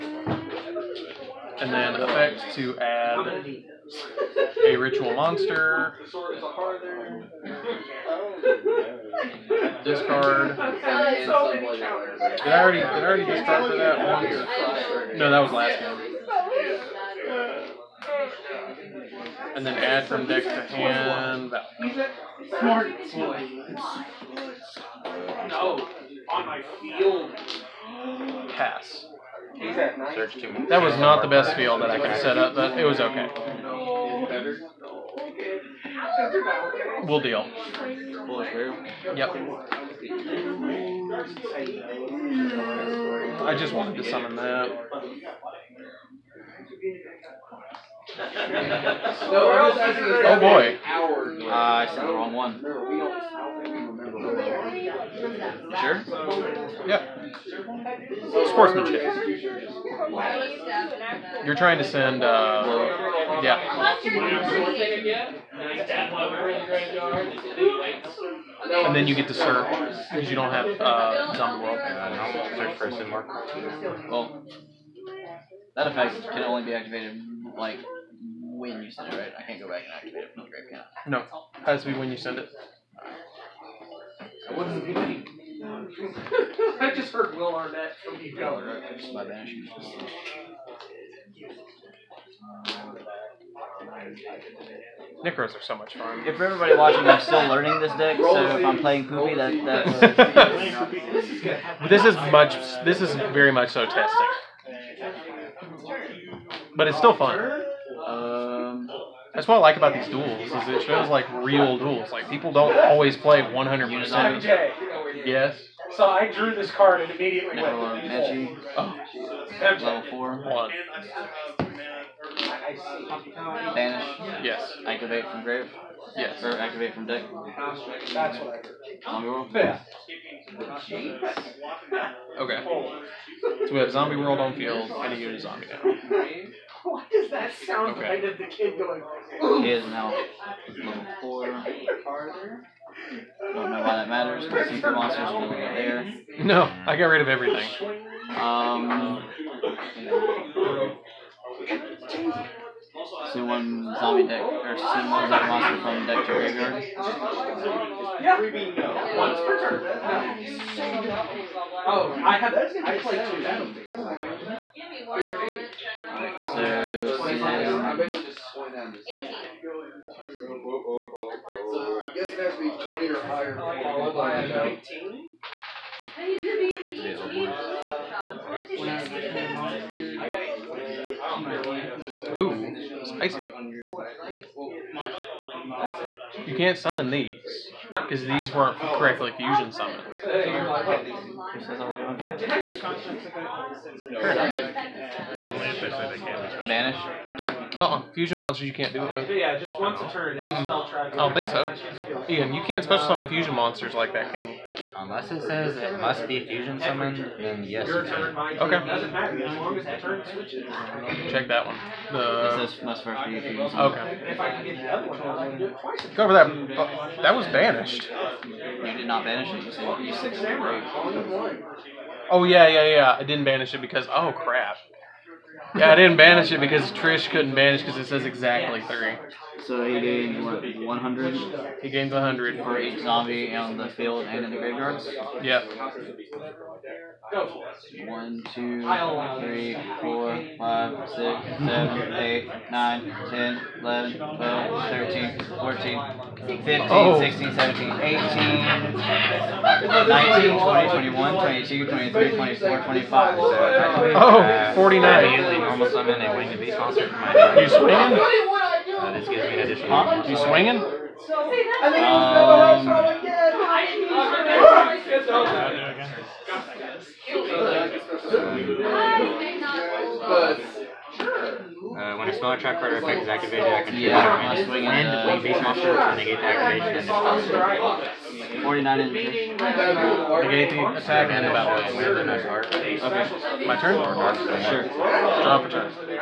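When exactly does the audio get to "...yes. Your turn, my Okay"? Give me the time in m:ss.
3:27.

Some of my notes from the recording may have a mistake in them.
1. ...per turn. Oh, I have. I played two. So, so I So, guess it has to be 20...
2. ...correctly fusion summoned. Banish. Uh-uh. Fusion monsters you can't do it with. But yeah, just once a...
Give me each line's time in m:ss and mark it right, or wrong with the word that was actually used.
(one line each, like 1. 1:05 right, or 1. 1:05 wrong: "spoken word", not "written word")
1. 2:39 right
2. 3:08 right.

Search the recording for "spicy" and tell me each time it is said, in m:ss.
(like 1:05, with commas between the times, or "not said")
3:03.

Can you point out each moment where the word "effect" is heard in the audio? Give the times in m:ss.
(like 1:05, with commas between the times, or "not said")
0:01, 1:15, 4:32.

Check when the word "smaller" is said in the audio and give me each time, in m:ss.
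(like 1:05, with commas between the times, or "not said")
4:32.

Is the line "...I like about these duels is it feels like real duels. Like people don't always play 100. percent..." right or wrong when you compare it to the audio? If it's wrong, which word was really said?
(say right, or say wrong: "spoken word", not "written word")
right.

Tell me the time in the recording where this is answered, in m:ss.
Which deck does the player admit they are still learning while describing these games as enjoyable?
1:35.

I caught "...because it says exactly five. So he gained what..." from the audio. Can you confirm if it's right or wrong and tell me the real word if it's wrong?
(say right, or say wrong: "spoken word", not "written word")
wrong: "three", not "five".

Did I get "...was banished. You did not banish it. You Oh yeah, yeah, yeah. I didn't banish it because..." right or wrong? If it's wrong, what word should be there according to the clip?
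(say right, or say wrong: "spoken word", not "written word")
right.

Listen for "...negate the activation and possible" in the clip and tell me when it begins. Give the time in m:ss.
4:36.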